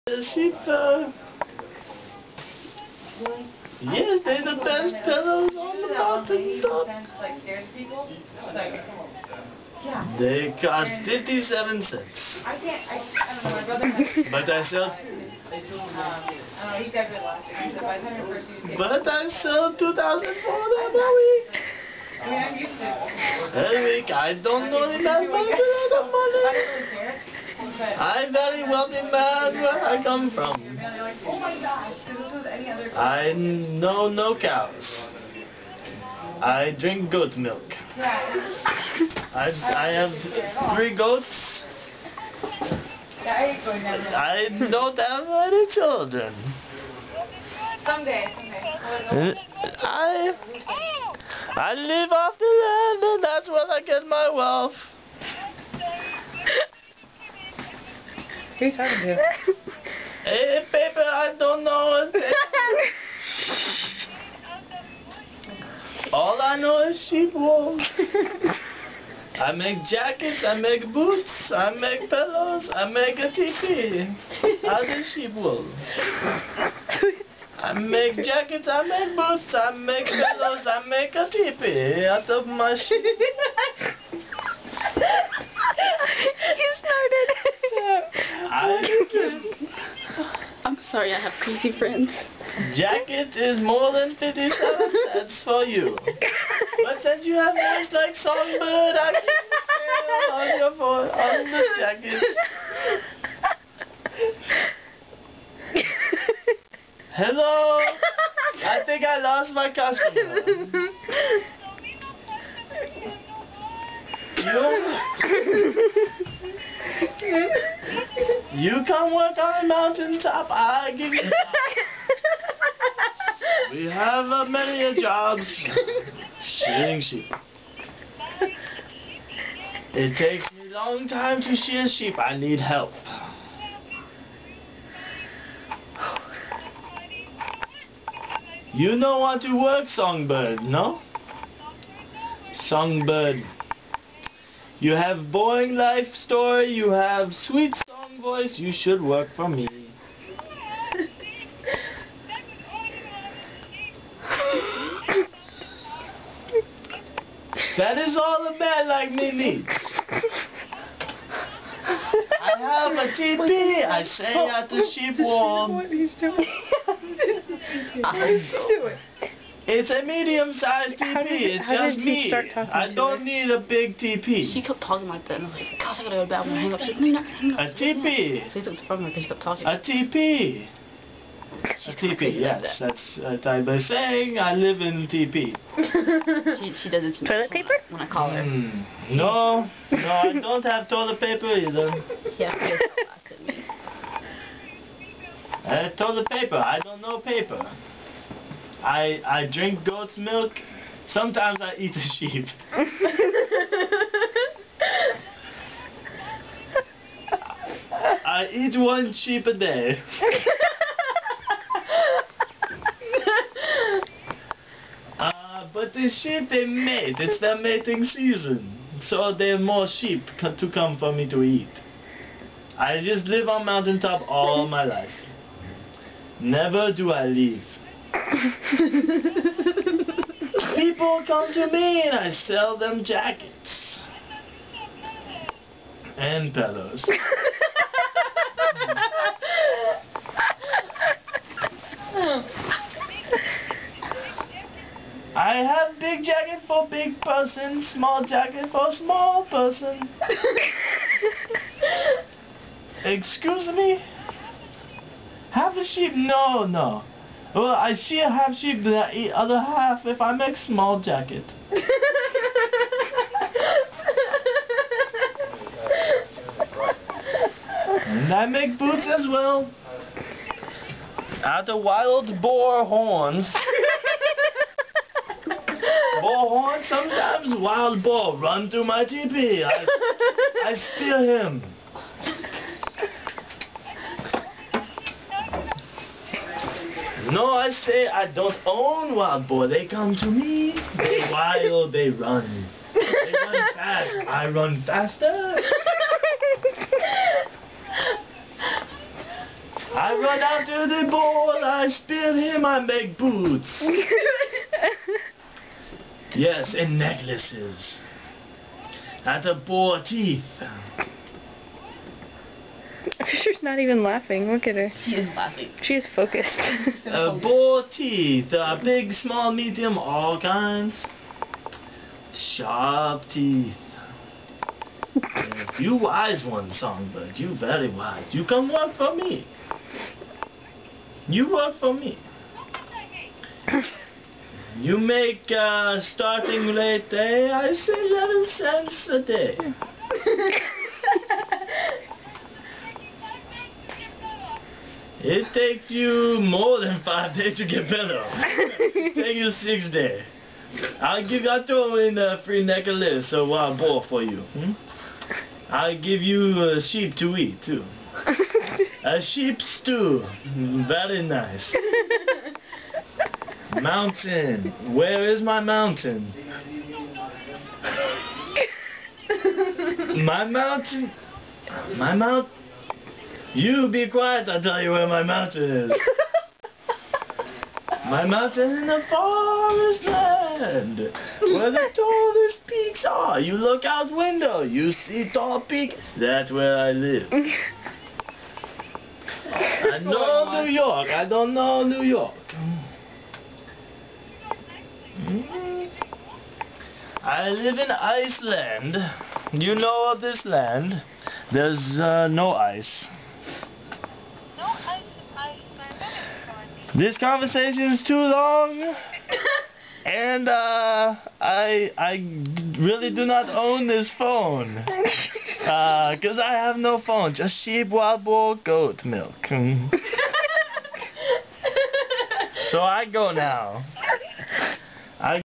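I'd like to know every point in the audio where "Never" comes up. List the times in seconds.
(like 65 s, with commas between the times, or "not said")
226 s.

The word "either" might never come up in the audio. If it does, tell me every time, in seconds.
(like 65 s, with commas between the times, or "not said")
191 s.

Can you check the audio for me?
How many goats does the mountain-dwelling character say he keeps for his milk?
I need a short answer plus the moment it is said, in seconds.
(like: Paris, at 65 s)
3, at 40 s.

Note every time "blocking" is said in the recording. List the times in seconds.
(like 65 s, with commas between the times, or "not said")
not said.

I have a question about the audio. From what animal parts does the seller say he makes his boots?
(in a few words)
wild boar horns.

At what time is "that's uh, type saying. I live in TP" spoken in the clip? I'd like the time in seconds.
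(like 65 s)
182 s.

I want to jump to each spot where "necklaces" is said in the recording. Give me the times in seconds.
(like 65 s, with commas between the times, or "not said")
306 s, 352 s.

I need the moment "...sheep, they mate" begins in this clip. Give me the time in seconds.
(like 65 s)
216 s.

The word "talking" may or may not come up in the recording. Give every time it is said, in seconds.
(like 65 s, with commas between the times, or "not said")
58 s, 174 s, 179 s.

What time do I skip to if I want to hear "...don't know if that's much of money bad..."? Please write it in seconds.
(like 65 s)
24 s.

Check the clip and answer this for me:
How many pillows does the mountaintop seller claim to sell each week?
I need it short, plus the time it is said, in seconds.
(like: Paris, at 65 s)
2,400, at 19 s.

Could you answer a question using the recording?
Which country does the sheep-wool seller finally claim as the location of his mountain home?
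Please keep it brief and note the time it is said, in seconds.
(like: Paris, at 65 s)
Iceland, at 397 s.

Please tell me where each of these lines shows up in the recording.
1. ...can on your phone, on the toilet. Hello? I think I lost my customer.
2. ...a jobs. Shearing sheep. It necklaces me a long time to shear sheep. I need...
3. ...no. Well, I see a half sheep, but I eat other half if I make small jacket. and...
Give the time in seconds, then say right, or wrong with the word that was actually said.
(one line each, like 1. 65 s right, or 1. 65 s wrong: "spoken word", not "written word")
1. 99 s wrong: "jacket", not "toilet"
2. 124 s wrong: "takes", not "necklaces"
3. 256 s right.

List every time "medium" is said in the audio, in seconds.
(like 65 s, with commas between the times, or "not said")
170 s, 319 s.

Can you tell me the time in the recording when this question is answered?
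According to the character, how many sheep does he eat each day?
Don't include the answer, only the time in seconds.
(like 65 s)
208 s.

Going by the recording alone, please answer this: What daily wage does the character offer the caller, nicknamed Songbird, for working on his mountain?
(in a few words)
11 cents.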